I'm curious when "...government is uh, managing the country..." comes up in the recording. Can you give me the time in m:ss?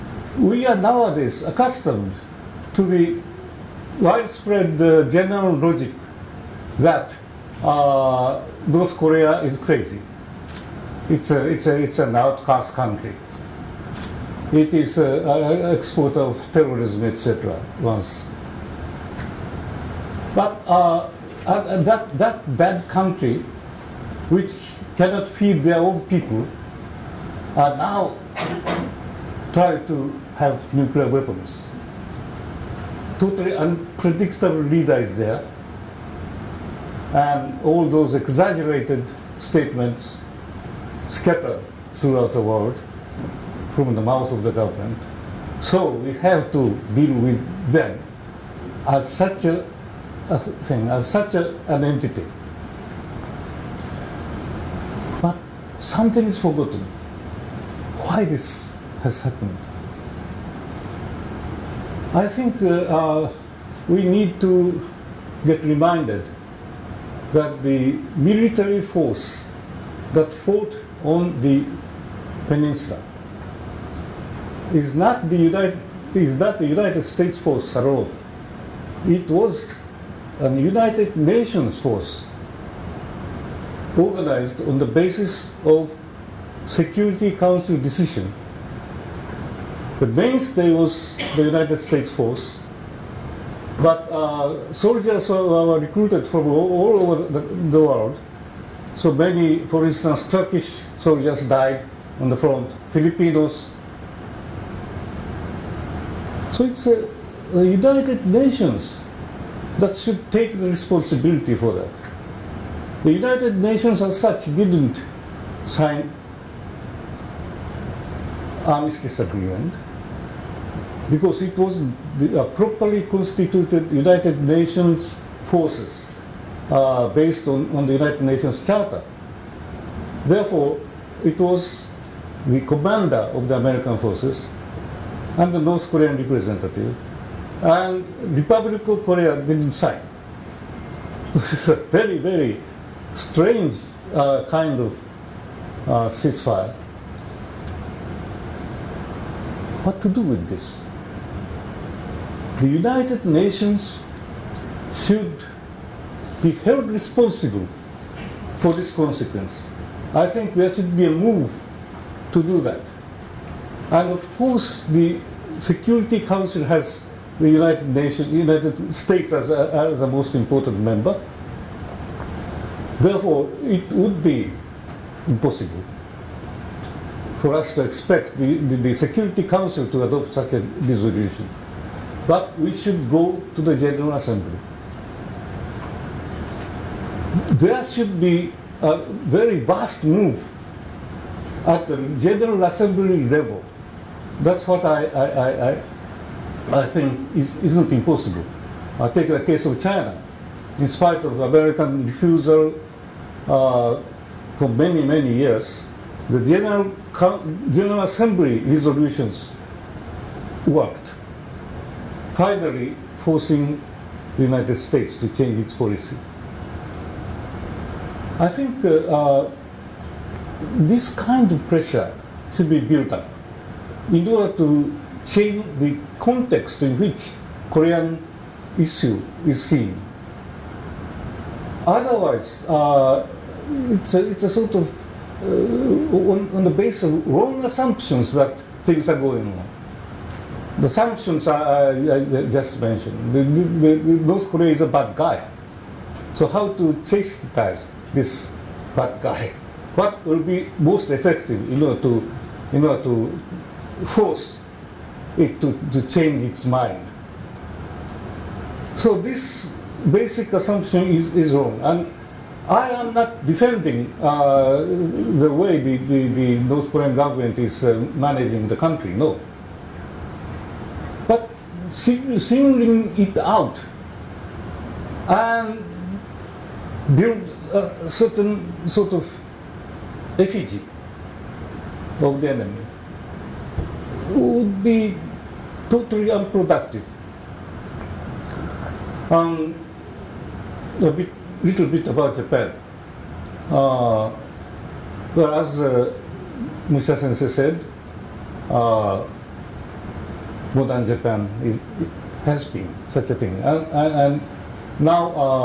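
4:27.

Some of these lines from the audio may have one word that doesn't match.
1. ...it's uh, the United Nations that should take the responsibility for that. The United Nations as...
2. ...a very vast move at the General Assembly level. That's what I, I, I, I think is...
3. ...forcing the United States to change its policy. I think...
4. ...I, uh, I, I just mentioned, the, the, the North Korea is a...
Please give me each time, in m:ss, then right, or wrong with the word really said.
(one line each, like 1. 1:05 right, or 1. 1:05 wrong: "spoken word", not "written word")
1. 1:46 right
2. 3:08 right
3. 3:33 right
4. 4:01 right.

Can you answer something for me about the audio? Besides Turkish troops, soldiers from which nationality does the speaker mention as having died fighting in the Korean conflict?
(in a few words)
Filipinos.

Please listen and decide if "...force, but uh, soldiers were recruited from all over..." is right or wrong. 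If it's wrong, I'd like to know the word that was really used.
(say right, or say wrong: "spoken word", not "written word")
right.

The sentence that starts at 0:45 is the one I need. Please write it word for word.
So we have to deal with them as such a, a thing, as such a, an entity.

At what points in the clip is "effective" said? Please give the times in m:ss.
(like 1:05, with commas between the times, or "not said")
4:11.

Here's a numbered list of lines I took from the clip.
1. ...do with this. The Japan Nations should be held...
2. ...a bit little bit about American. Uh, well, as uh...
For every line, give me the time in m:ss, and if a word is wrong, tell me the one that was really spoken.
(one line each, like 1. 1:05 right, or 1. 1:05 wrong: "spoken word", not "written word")
1. 2:30 wrong: "United", not "Japan"
2. 4:51 wrong: "Japan", not "American".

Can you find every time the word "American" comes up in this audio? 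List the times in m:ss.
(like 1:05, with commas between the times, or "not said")
2:13, 3:21.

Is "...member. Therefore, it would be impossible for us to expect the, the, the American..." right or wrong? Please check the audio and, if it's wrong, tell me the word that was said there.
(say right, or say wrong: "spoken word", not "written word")
wrong: "Security", not "American".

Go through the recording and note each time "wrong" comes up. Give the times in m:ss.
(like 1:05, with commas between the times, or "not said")
3:57, 4:21.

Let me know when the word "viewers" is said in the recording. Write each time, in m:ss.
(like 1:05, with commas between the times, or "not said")
not said.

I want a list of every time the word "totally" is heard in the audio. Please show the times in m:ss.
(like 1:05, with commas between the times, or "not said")
0:33, 4:45.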